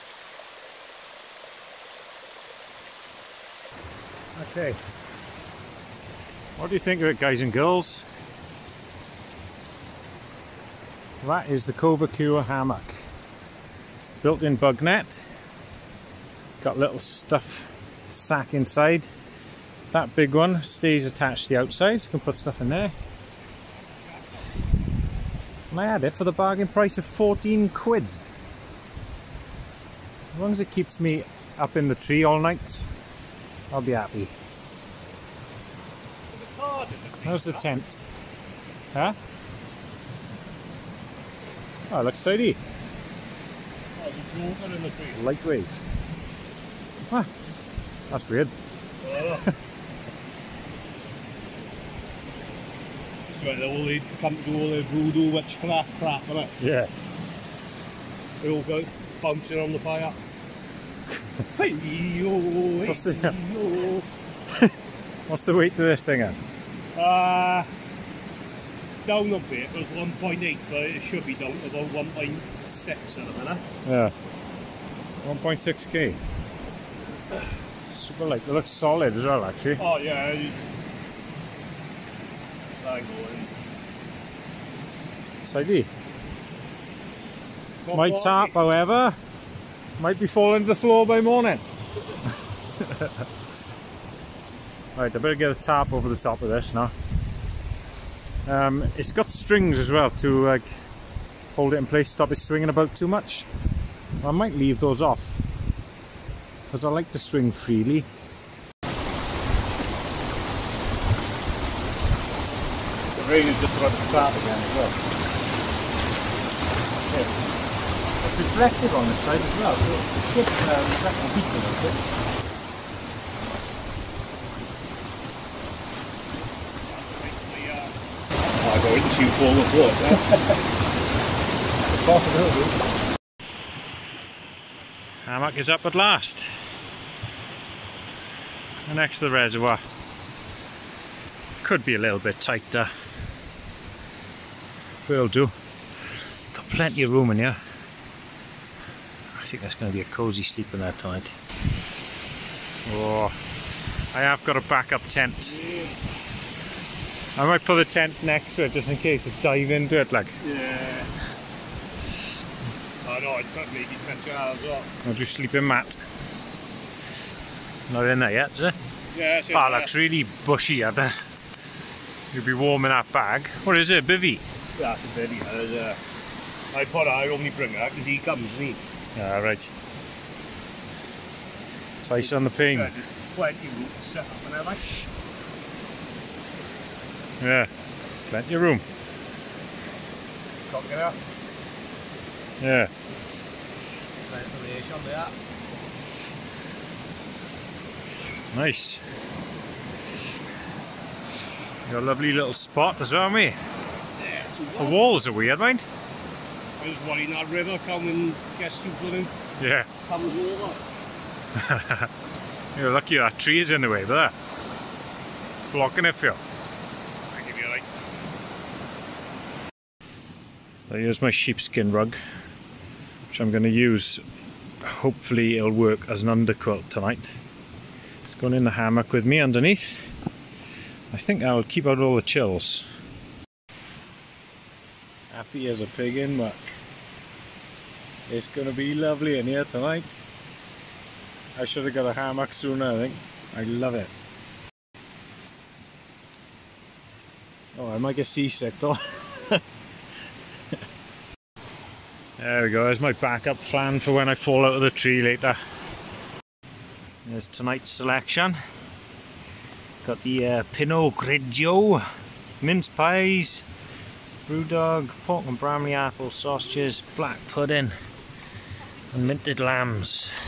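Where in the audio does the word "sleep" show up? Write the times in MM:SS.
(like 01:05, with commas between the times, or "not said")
02:30, 02:45.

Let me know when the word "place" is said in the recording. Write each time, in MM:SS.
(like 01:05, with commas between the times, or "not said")
01:41, 03:02.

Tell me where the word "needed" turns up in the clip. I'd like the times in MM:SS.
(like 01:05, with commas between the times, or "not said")
not said.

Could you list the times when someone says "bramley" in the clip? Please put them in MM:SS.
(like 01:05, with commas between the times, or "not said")
04:25.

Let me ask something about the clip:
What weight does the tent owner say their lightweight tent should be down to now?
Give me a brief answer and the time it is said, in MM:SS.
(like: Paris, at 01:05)
1.6k, at 01:15.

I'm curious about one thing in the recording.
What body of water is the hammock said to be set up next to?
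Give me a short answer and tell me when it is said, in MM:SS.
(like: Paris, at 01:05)
The reservoir, at 02:19.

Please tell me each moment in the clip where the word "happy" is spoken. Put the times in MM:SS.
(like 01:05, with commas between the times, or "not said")
00:33, 03:55.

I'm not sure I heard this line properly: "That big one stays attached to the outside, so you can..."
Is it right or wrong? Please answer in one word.
right.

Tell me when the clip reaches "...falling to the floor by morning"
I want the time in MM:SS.
01:30.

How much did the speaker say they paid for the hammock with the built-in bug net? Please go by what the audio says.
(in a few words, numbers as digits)
14 quid.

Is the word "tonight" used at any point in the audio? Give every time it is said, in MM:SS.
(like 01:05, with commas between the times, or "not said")
02:30, 03:46, 03:59, 04:17.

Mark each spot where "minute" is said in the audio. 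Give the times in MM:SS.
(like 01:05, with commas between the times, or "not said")
01:13.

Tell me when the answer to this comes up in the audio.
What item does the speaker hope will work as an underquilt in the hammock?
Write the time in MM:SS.
03:41.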